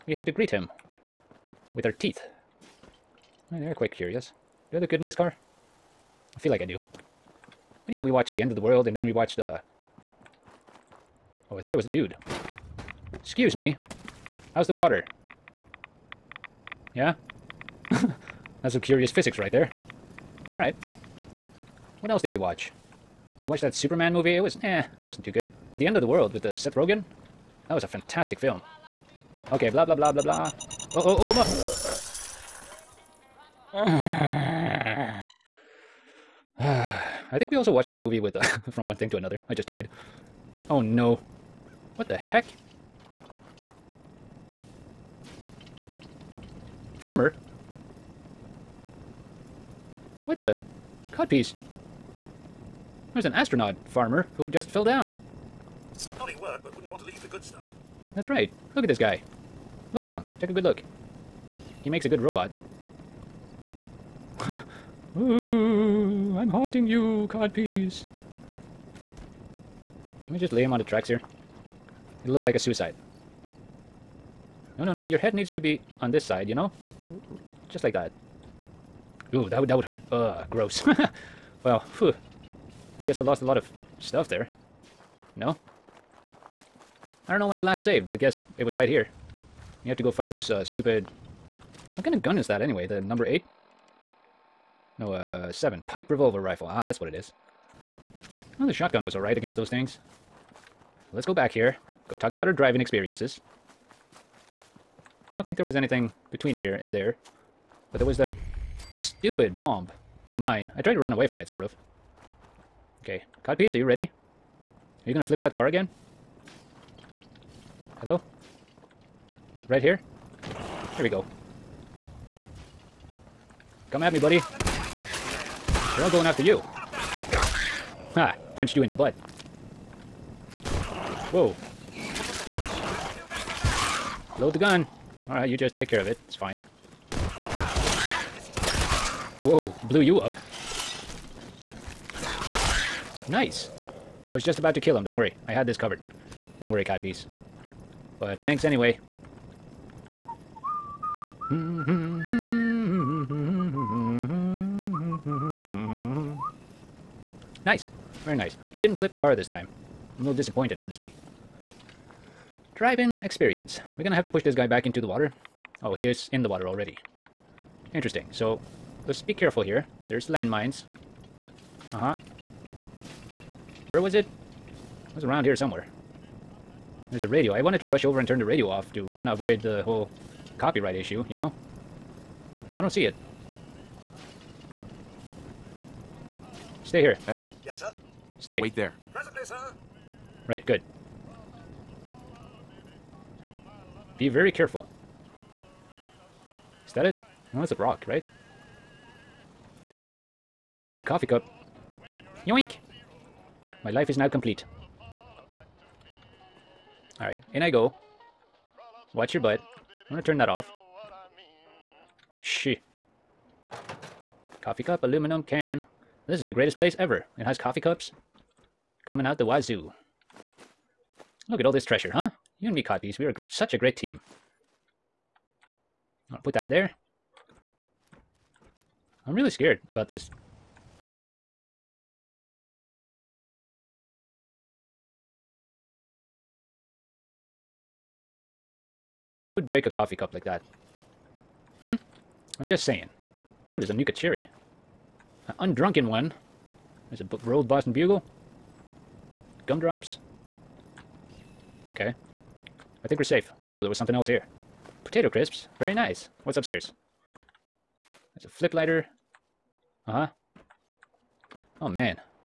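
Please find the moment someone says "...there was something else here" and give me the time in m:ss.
4:13.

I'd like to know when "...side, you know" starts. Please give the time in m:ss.
1:16.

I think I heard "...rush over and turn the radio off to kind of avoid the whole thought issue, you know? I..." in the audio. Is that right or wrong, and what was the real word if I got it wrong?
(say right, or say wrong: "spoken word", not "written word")
wrong: "copyright", not "thought".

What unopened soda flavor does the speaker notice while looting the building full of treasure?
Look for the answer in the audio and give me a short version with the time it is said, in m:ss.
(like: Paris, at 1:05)
Nuka Cherry, at 4:03.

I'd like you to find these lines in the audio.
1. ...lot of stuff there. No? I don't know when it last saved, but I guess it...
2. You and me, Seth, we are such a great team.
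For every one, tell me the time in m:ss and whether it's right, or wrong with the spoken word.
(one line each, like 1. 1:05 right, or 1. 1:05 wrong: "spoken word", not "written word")
1. 1:23 right
2. 3:42 wrong: "Codpiece", not "Seth".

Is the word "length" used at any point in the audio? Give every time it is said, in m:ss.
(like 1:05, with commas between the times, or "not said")
not said.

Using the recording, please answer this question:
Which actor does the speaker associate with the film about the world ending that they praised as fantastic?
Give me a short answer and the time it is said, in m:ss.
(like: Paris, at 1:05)
Seth Rogen, at 0:26.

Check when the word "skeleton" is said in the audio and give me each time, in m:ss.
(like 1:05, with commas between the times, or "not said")
not said.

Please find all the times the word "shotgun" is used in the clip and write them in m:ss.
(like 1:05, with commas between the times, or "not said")
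1:38.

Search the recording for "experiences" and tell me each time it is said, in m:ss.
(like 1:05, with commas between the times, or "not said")
1:42, 2:43.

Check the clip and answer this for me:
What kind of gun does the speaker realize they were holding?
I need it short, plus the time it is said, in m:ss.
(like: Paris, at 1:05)
Pipe revolver rifle, at 1:35.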